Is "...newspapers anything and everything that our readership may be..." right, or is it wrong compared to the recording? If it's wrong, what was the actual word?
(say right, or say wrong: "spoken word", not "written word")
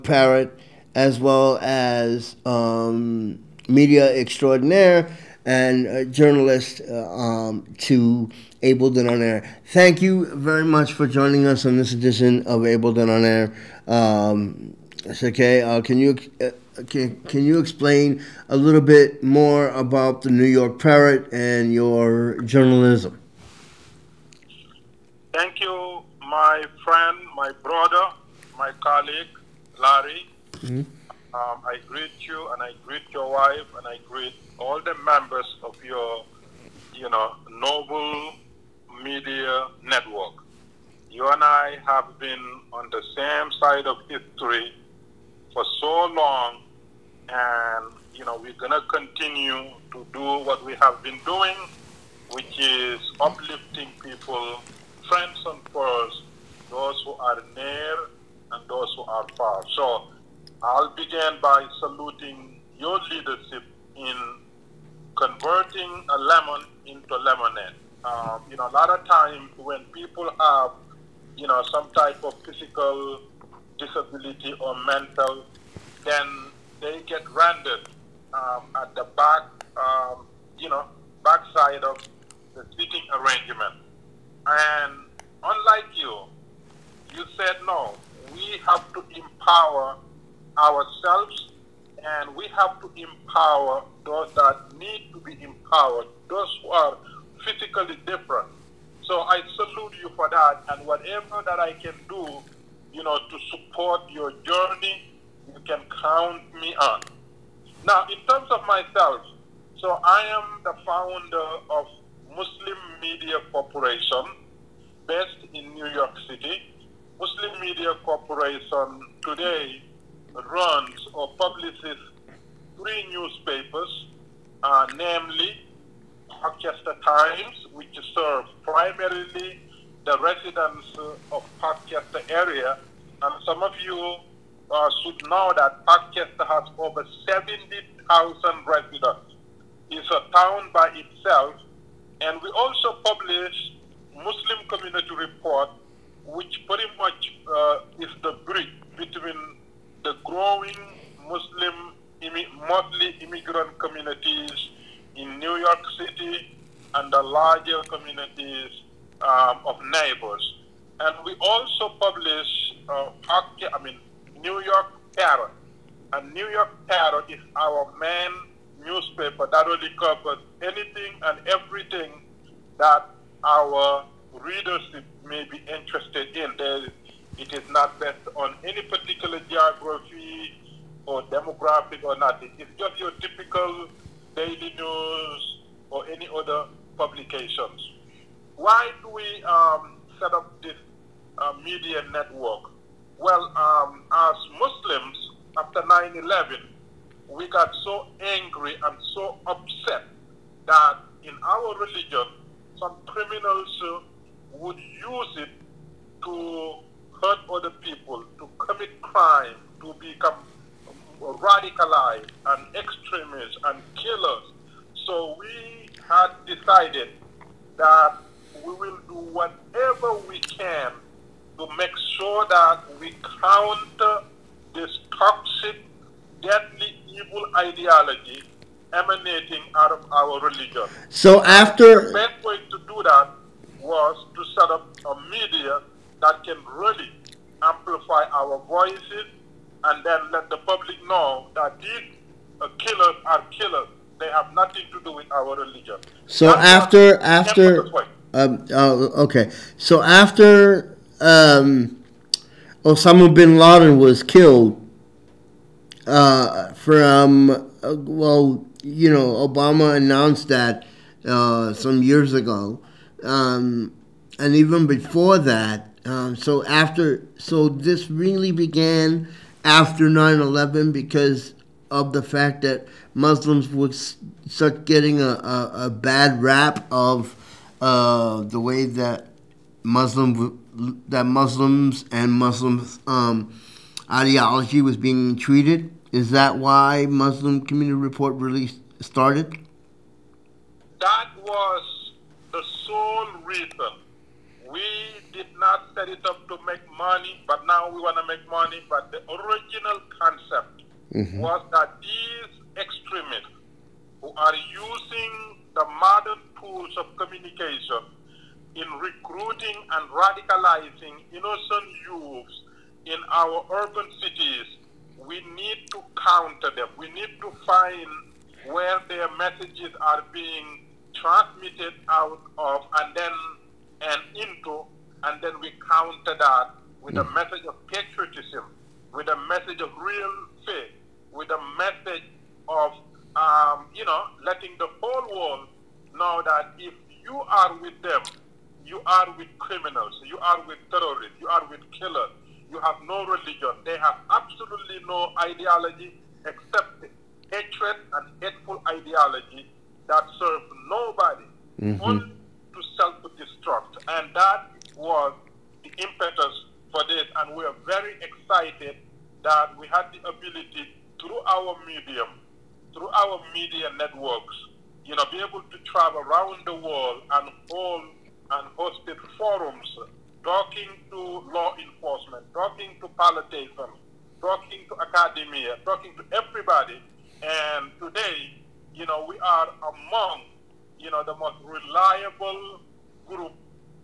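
wrong: "covers", not "newspapers".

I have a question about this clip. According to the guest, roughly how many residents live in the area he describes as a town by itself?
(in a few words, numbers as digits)
70,000.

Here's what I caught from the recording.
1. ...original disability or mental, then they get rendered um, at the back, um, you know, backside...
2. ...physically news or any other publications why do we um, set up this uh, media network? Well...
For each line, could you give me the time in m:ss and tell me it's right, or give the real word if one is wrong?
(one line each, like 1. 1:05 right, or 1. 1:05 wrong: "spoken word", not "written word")
1. 1:12 wrong: "physical", not "original"
2. 3:04 wrong: "daily", not "physically".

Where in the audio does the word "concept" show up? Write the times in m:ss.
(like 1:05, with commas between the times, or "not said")
5:00.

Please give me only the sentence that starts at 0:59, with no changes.
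So I'll begin by saluting your leadership in converting a lemon into lemonade.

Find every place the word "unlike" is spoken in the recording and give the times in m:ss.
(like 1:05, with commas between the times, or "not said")
1:25.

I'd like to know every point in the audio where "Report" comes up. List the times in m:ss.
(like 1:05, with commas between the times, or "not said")
2:25, 4:47.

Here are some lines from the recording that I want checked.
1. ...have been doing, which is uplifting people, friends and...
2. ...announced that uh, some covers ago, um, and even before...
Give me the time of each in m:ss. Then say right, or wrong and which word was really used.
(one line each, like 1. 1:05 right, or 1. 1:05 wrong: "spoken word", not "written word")
1. 0:50 right
2. 4:19 wrong: "years", not "covers".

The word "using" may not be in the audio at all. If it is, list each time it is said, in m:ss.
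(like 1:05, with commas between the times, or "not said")
5:04.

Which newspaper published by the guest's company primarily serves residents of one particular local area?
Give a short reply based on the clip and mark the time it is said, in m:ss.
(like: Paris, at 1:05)
Parkchester Times, at 2:06.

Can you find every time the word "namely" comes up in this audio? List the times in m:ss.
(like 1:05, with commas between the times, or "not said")
2:04.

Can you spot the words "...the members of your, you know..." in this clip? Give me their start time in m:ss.
0:34.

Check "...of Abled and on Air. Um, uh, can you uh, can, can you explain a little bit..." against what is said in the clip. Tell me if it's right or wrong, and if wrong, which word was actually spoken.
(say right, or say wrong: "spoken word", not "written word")
right.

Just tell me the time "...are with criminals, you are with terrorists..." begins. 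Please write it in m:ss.
5:39.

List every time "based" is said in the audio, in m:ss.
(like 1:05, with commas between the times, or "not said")
1:55, 2:57.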